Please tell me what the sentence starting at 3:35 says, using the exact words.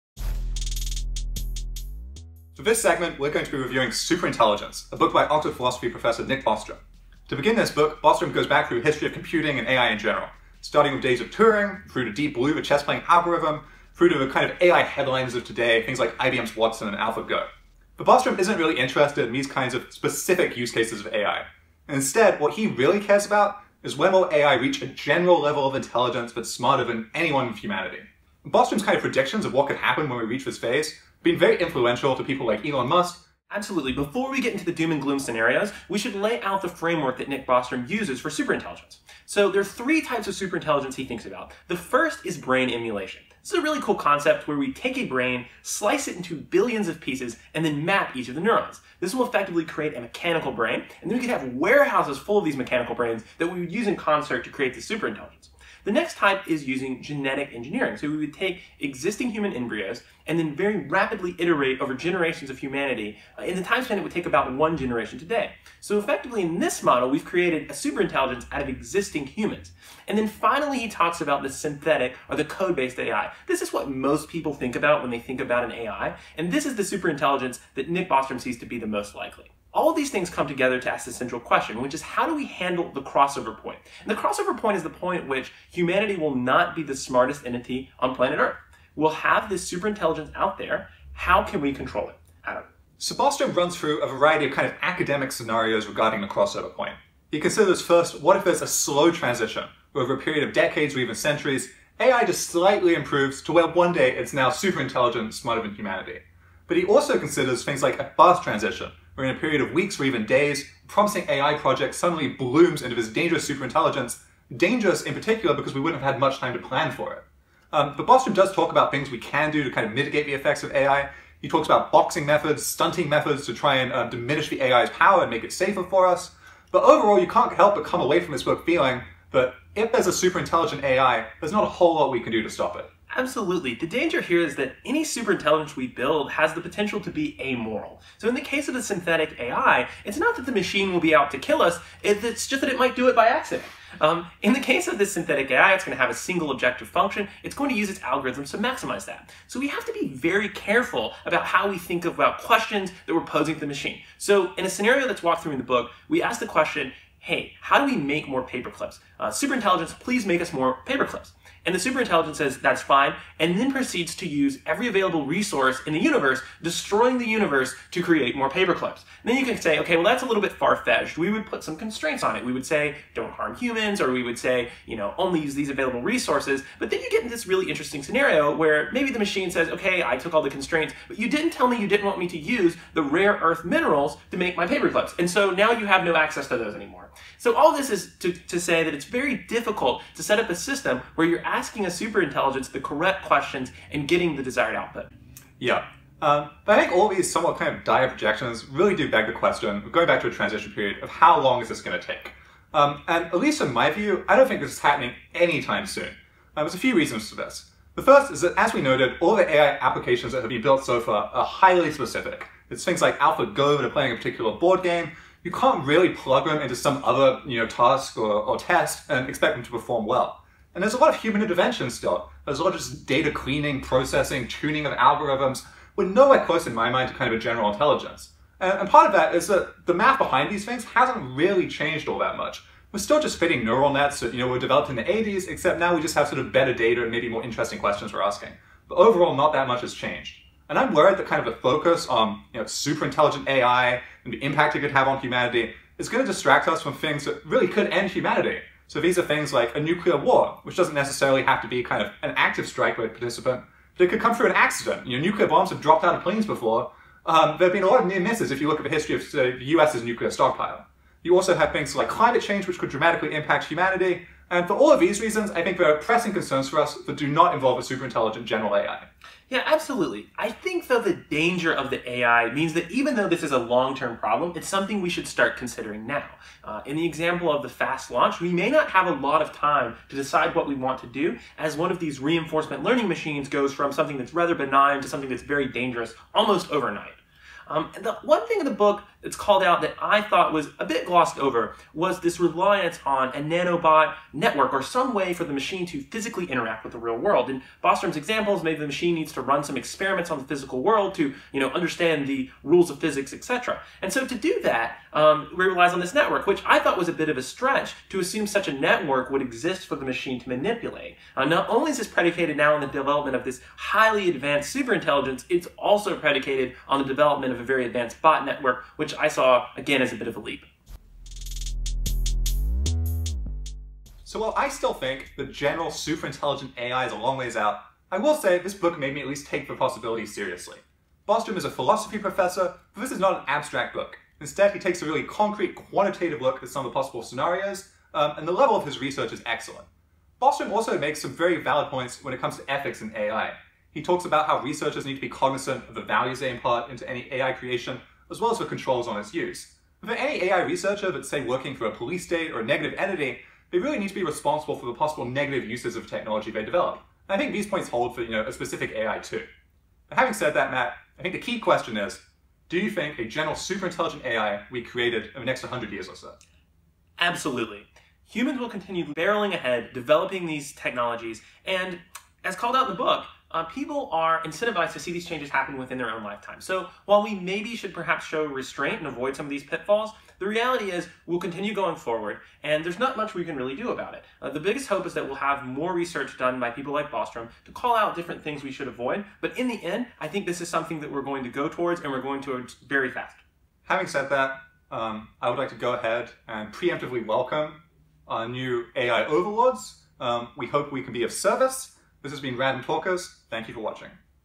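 You can't really plug them into some other you know, task or, or test and expect them to perform well.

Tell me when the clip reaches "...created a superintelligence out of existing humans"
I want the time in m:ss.
1:07.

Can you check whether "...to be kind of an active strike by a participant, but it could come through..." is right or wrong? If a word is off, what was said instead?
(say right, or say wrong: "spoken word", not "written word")
right.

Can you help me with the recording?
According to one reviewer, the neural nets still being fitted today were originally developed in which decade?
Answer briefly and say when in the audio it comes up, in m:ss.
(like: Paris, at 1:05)
the 80s, at 3:55.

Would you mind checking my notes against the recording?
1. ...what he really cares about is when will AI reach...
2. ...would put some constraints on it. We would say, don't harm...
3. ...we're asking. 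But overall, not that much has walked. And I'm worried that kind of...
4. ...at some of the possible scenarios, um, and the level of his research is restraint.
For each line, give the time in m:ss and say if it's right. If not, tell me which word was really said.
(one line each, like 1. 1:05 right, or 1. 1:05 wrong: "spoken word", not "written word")
1. 0:22 right
2. 2:51 right
3. 3:58 wrong: "changed", not "walked"
4. 5:36 wrong: "excellent", not "restraint".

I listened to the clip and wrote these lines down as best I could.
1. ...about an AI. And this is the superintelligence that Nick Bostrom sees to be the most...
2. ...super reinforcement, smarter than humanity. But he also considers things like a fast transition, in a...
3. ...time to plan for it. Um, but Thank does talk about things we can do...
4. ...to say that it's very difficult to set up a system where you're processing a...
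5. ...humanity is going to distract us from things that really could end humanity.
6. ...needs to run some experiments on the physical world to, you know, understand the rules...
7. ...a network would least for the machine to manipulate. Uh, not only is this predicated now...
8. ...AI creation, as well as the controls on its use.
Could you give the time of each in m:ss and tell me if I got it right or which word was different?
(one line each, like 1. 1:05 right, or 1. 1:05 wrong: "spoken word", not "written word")
1. 1:15 right
2. 1:44 wrong: "intelligent", not "reinforcement"
3. 1:56 wrong: "Bostrom", not "Thank"
4. 3:08 wrong: "asking", not "processing"
5. 4:05 right
6. 4:59 right
7. 5:08 wrong: "exist", not "least"
8. 5:47 right.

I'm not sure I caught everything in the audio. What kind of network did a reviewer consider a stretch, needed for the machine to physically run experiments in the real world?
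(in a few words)
a nanobot network.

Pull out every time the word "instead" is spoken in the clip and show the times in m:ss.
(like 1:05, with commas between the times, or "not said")
0:21, 5:34.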